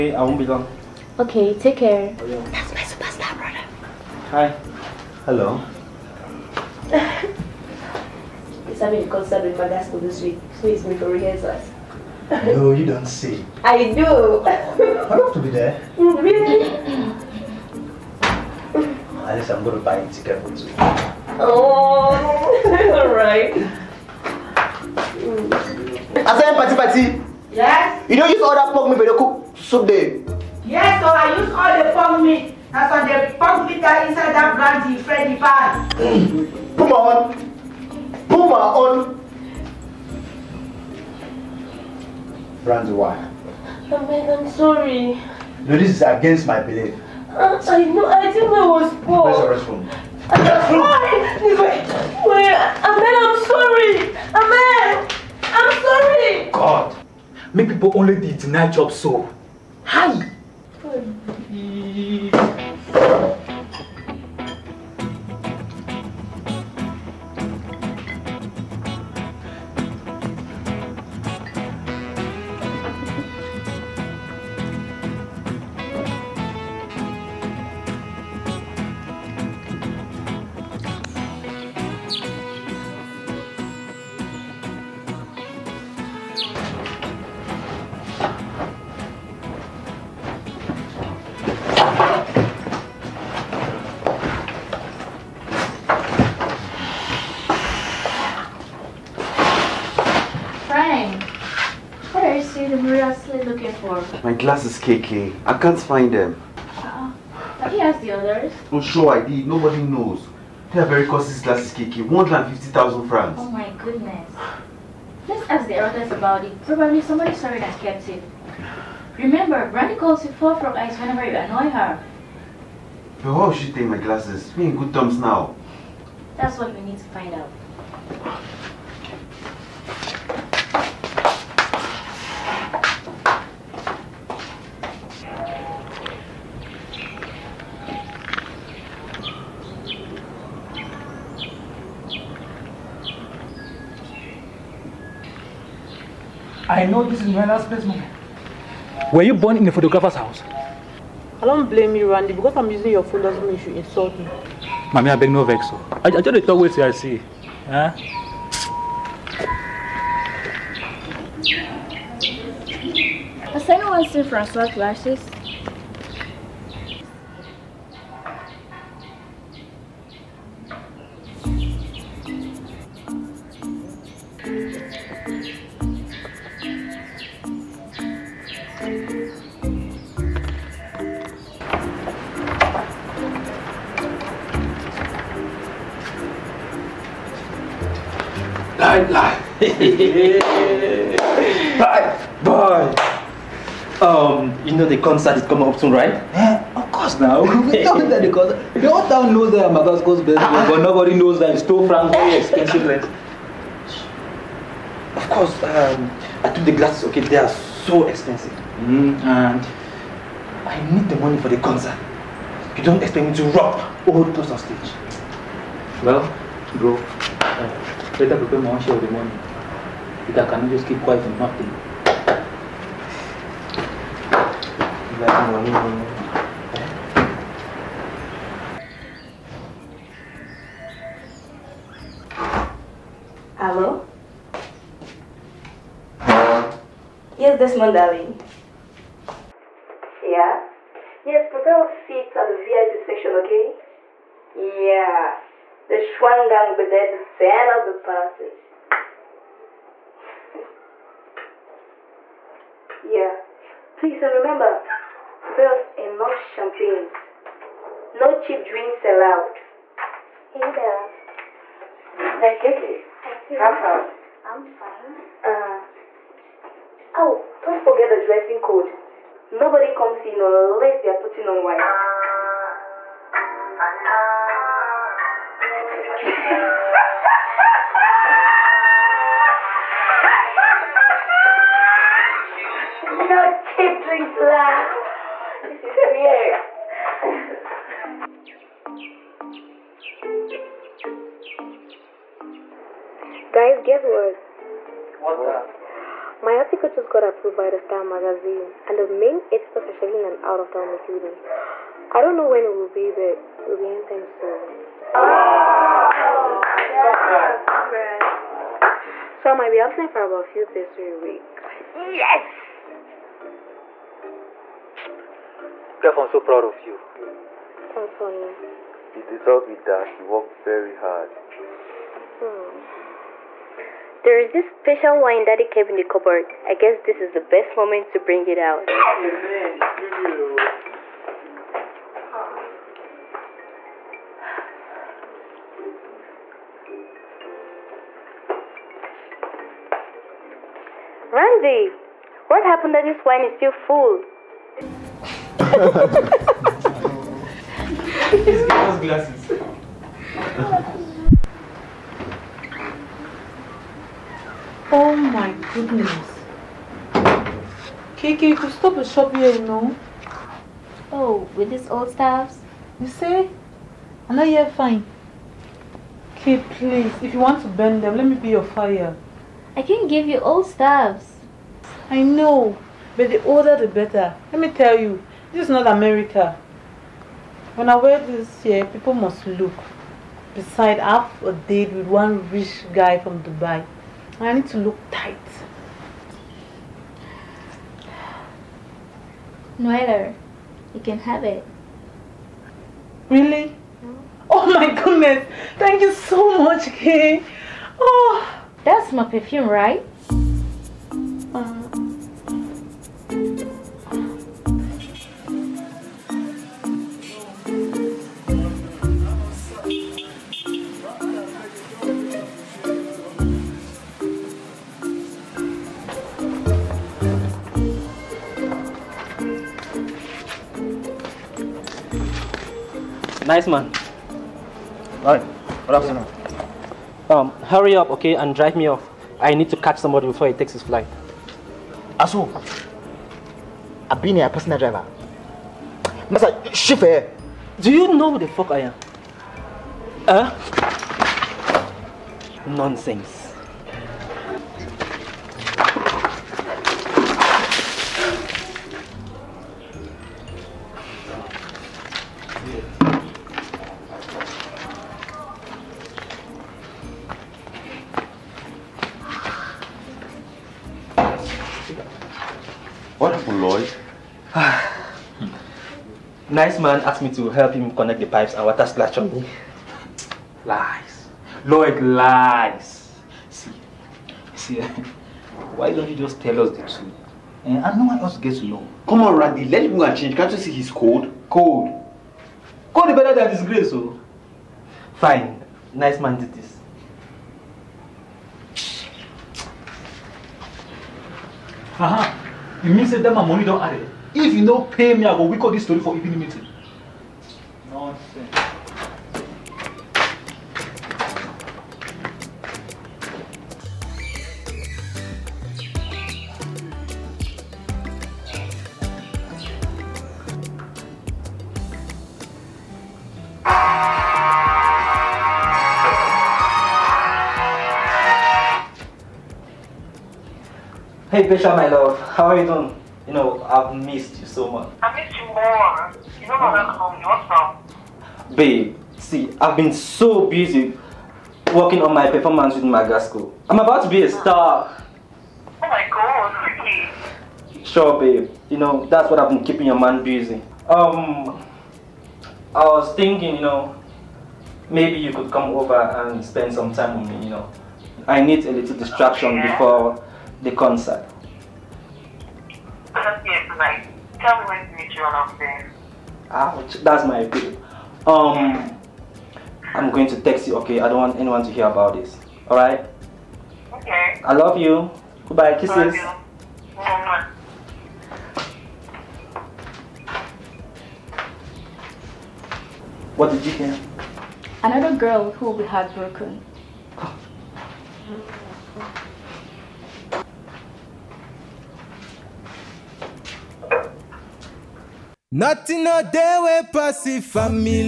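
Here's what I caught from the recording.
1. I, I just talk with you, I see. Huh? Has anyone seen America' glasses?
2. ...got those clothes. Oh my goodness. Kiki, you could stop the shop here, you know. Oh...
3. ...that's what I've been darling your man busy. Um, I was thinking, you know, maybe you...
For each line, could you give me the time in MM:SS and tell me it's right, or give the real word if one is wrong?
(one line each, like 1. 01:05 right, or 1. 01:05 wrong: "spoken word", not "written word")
1. 02:35 wrong: "Francois", not "America"
2. 05:48 wrong: "glasses", not "clothes"
3. 08:59 wrong: "keeping", not "darling".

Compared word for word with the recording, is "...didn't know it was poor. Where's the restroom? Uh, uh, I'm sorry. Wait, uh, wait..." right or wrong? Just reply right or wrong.
right.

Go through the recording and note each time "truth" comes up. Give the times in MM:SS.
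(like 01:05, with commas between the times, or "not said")
07:56.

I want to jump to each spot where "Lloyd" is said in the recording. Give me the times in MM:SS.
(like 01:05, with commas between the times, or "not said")
07:43, 07:51.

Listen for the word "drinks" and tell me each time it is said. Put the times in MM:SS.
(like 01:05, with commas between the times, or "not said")
04:18, 04:44.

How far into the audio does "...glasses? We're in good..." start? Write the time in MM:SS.
02:03.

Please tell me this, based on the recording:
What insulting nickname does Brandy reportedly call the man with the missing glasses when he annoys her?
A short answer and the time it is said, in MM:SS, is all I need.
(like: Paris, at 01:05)
four frog eyes, at 02:00.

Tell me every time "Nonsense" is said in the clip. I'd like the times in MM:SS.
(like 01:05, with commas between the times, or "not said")
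07:22, 08:17.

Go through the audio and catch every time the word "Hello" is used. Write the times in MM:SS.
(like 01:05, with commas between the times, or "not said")
00:05, 03:53.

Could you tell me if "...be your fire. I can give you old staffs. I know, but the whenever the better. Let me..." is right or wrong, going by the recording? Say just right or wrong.
wrong.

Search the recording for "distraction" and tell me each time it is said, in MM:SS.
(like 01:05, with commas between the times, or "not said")
09:08.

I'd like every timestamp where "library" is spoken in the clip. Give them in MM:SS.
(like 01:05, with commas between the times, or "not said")
not said.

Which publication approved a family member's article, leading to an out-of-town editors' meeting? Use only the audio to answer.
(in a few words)
Star magazine.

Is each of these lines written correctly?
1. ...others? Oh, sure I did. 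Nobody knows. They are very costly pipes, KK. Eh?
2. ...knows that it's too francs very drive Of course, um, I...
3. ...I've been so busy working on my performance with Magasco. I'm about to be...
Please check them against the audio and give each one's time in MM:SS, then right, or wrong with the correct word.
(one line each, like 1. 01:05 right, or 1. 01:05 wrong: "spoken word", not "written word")
1. 01:48 wrong: "glasses", not "pipes"
2. 03:21 wrong: "expensive", not "drive"
3. 08:49 right.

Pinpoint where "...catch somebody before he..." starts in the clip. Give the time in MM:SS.
07:09.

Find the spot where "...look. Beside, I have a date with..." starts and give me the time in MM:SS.
06:19.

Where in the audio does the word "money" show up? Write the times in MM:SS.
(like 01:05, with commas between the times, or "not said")
03:31, 03:39, 08:13.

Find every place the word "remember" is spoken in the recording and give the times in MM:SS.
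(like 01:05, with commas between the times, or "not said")
01:59, 04:14.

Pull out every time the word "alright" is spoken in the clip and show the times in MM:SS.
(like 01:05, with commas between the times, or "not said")
00:22, 07:05, 09:22.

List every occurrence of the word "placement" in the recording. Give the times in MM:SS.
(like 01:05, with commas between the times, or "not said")
02:27.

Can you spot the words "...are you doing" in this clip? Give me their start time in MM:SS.
08:42.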